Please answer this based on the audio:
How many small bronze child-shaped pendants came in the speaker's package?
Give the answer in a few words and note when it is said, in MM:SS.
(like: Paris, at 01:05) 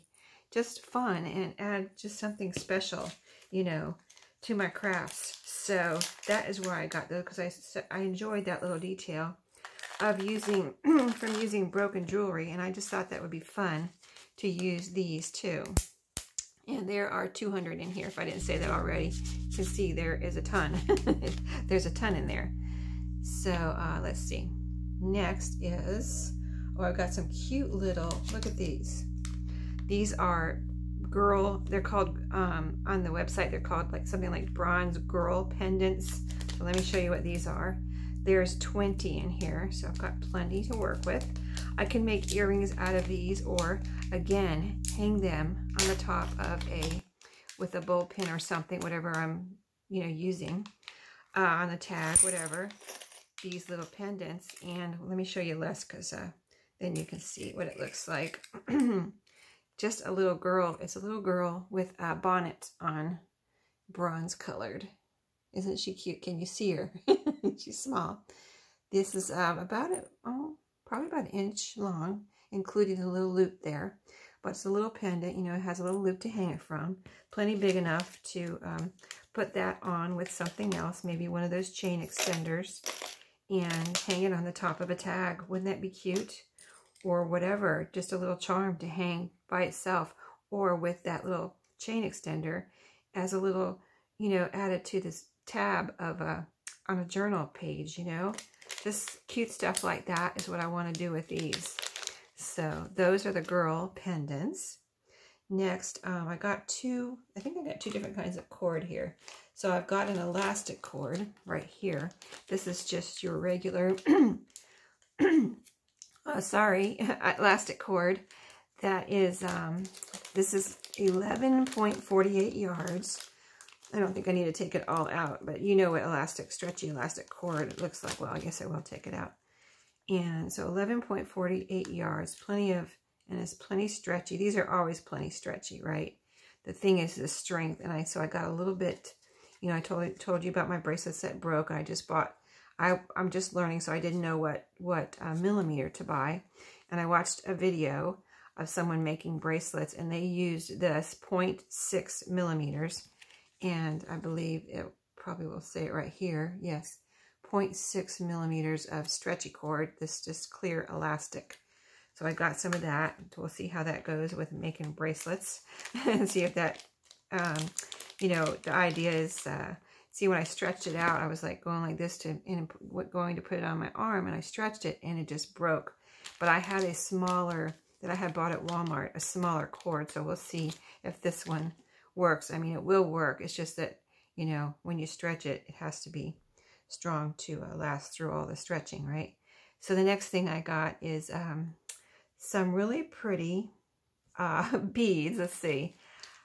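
20, at 00:38.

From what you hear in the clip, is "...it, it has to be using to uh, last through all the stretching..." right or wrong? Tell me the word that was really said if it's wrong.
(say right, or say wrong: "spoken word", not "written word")
wrong: "strong", not "using".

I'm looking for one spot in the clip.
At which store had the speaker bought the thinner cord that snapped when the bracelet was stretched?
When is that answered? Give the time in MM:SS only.
02:58.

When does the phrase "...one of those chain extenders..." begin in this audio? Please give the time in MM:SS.
01:21.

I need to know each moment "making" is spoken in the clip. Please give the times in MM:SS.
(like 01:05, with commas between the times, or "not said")
02:29, 02:44.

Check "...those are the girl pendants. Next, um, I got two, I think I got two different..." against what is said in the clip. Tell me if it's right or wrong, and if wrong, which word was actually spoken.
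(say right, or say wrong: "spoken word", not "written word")
right.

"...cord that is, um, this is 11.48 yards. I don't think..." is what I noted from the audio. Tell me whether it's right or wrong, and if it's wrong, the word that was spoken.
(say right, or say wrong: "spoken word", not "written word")
right.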